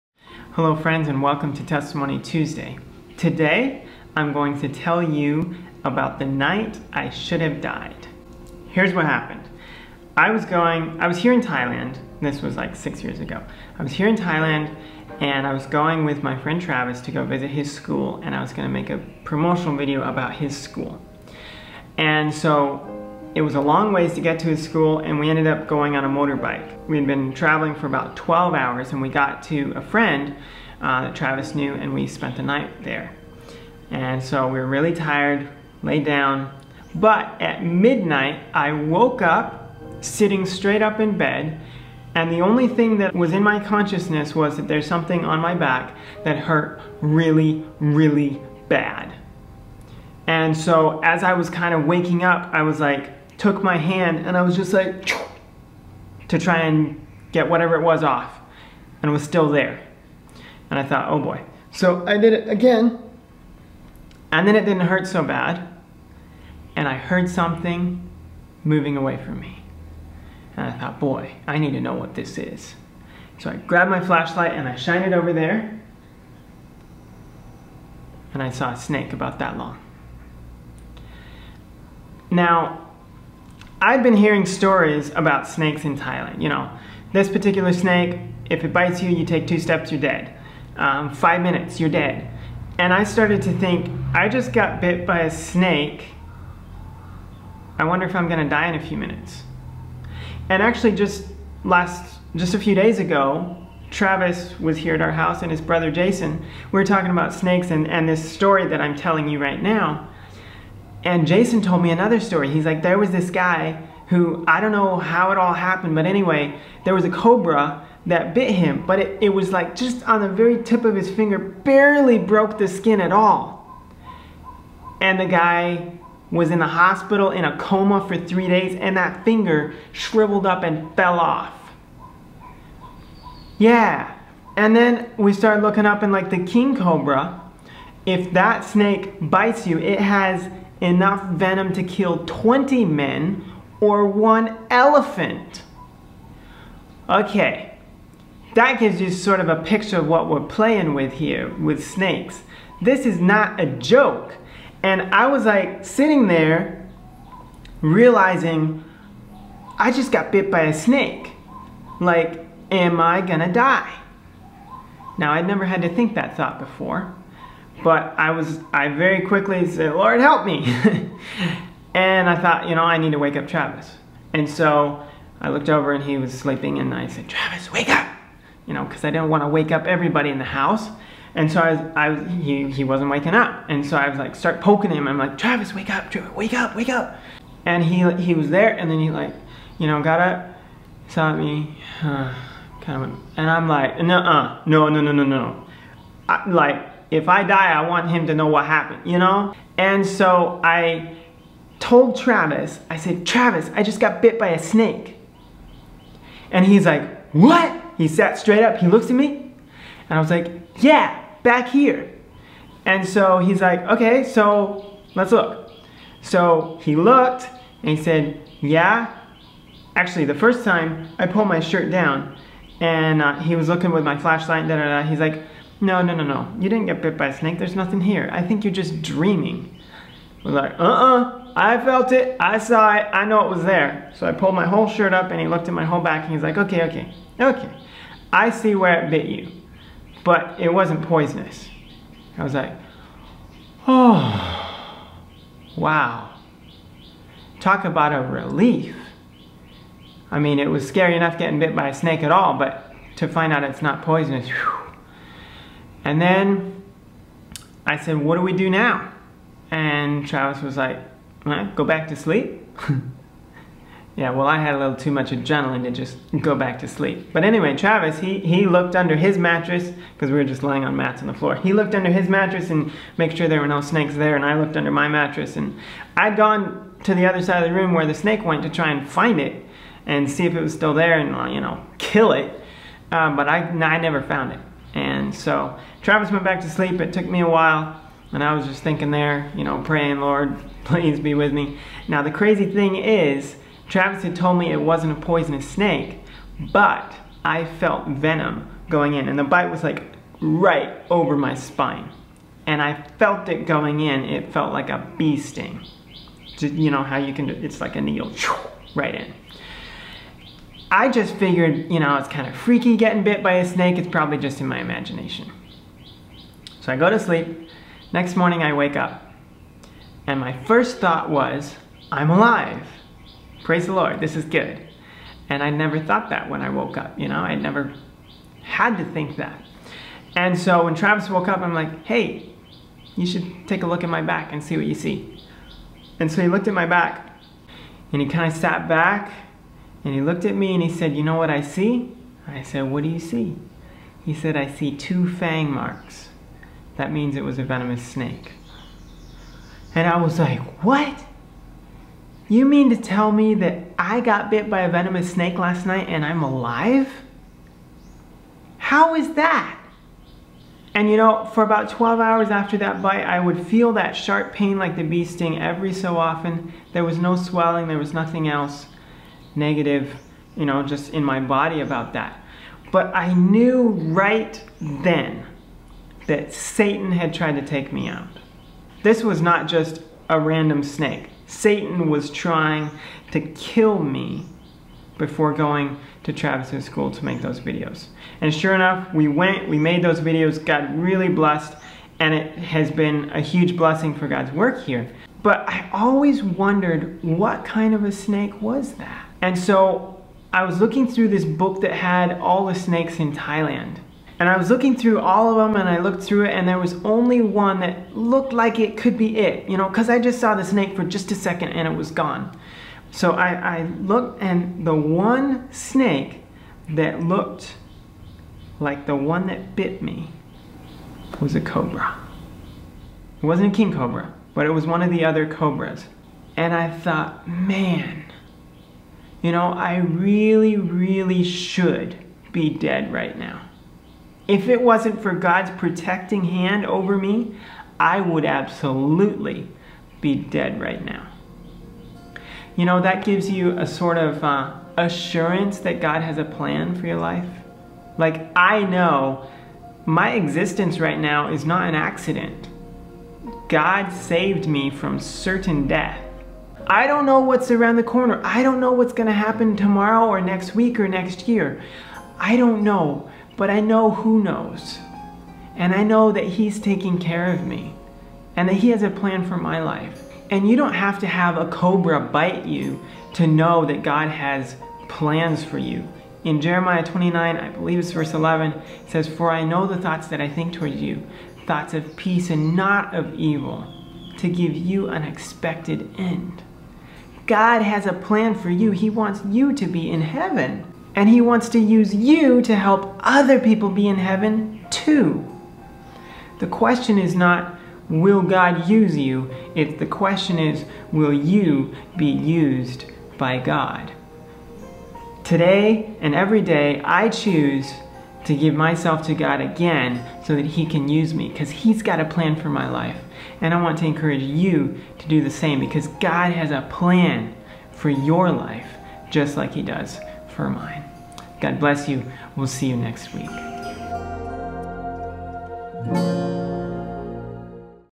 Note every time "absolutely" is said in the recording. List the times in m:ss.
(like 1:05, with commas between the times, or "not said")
7:18.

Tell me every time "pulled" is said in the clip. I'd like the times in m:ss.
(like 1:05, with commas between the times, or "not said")
3:41, 3:54.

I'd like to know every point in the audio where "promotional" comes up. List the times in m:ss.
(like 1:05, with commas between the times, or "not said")
0:19.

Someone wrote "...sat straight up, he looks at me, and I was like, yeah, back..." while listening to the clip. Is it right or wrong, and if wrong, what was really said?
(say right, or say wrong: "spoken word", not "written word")
right.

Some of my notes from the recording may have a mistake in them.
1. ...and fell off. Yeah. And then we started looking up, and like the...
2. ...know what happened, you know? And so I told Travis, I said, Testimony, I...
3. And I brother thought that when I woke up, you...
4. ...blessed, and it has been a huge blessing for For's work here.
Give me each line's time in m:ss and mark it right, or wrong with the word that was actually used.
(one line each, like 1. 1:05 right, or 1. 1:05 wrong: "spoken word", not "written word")
1. 2:10 right
2. 3:18 wrong: "Travis", not "Testimony"
3. 5:25 wrong: "never", not "brother"
4. 6:31 wrong: "God", not "For".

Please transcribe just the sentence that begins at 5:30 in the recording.
And so when Travis woke up, I'm like, hey, you should take a look at my back and see what you see.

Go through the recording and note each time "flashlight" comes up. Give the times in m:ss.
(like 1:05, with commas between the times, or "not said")
1:14, 3:44.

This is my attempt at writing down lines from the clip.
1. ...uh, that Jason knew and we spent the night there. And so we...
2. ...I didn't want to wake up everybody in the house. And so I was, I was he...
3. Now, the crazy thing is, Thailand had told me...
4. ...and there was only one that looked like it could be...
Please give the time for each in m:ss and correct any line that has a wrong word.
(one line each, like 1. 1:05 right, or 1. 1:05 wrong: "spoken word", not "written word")
1. 0:30 wrong: "Travis", not "Jason"
2. 2:59 right
3. 4:52 wrong: "Travis", not "Thailand"
4. 6:46 right.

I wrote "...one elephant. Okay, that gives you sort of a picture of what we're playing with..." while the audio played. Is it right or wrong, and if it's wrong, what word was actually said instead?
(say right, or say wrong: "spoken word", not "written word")
right.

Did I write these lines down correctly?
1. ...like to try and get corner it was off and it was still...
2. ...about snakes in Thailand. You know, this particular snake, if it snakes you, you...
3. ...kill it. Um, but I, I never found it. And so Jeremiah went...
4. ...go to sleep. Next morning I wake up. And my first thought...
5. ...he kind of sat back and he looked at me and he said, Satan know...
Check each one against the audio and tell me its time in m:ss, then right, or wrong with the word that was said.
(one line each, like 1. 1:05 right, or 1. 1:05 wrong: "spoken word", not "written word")
1. 0:54 wrong: "whatever", not "corner"
2. 1:25 wrong: "bites", not "snakes"
3. 4:41 wrong: "Travis", not "Jeremiah"
4. 5:16 right
5. 5:38 wrong: "You", not "Satan".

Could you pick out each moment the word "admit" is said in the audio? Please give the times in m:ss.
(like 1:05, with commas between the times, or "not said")
not said.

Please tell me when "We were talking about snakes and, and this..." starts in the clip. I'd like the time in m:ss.
1:46.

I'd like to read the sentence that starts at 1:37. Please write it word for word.
I wonder if I'm gonna die in a few minutes.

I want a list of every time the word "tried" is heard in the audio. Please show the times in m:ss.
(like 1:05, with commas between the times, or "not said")
6:17.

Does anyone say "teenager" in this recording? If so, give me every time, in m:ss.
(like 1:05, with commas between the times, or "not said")
not said.